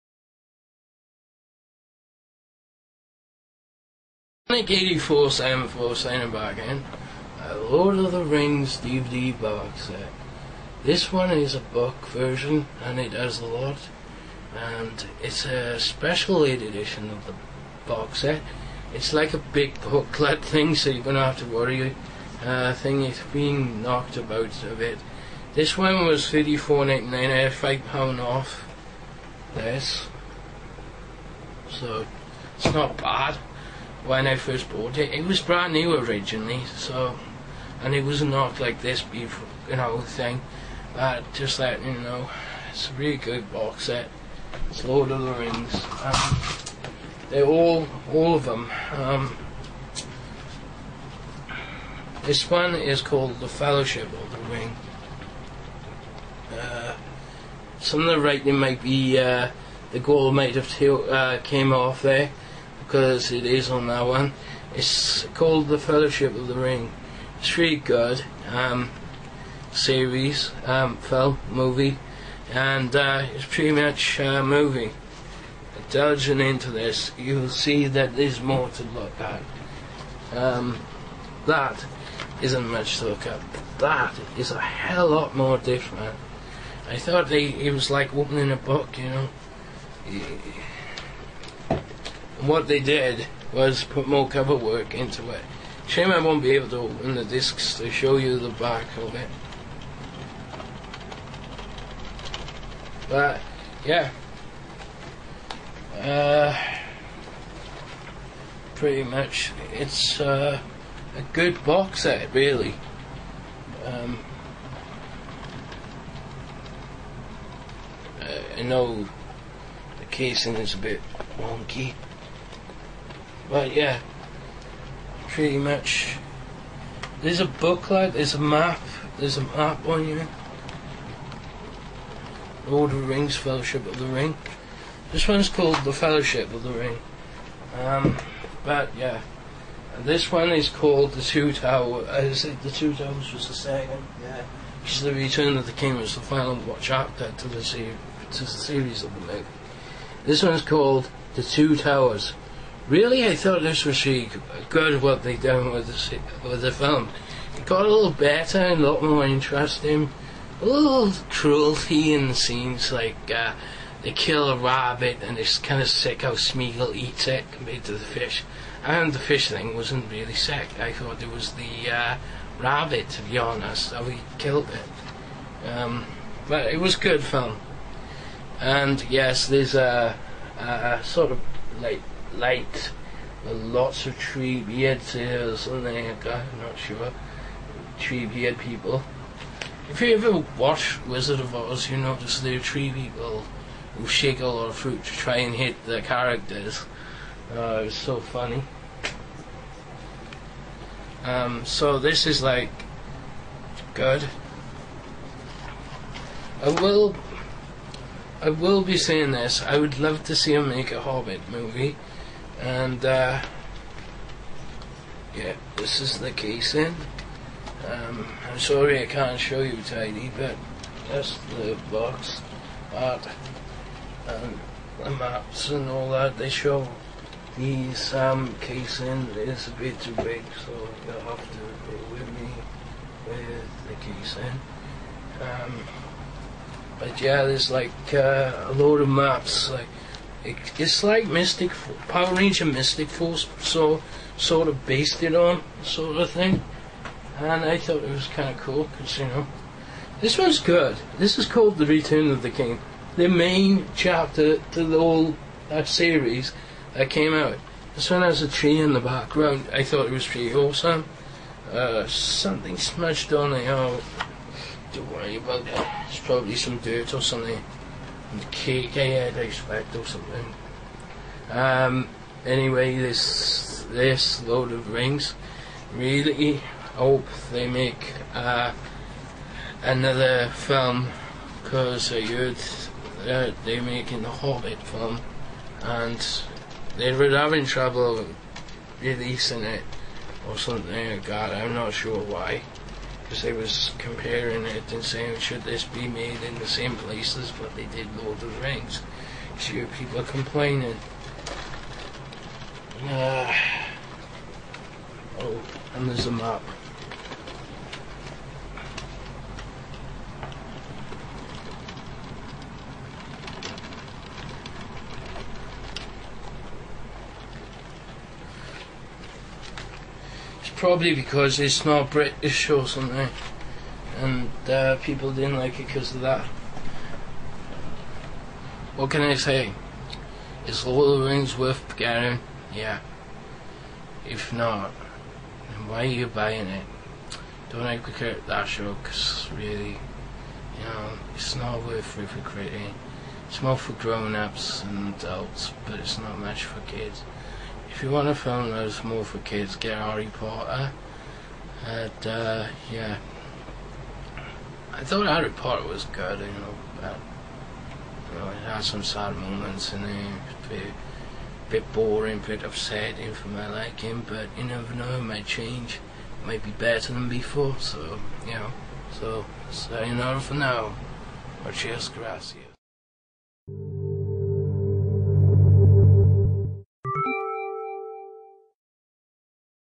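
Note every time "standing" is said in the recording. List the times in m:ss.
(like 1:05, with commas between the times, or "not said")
0:05.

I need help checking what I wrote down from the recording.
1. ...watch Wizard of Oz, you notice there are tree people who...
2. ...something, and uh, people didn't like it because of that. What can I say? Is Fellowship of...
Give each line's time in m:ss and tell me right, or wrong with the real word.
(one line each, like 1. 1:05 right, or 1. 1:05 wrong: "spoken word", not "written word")
1. 3:10 right
2. 5:22 wrong: "Lord", not "Fellowship".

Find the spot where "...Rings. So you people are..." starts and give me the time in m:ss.
4:58.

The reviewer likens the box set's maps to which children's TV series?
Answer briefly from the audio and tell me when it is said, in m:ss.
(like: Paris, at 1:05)
Power Ranger Mystic Force, at 4:02.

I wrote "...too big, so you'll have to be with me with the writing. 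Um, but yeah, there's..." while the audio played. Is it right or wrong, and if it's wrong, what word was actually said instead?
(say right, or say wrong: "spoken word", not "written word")
wrong: "casing", not "writing".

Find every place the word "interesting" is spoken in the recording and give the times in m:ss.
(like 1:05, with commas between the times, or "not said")
2:39.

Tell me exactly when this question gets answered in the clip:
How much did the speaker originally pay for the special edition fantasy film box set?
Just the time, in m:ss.
0:26.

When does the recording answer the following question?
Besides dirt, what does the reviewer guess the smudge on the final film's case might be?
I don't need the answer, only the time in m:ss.
4:28.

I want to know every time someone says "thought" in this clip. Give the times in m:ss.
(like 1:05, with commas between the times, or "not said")
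1:26, 2:33, 2:50, 4:07, 4:19, 5:55.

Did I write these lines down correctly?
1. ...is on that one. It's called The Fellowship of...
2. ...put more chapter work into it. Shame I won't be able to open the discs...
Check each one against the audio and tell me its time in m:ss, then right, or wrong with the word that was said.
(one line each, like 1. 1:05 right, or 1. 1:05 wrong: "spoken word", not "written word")
1. 1:03 right
2. 1:33 wrong: "cover", not "chapter".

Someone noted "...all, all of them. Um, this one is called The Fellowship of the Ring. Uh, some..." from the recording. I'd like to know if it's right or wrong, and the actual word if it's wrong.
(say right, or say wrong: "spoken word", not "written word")
right.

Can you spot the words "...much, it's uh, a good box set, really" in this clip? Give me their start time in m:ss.
1:49.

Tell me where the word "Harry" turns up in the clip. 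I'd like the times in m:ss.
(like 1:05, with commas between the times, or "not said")
5:49, 5:55.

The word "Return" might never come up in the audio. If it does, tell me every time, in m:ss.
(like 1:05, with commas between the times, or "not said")
2:25, 4:11.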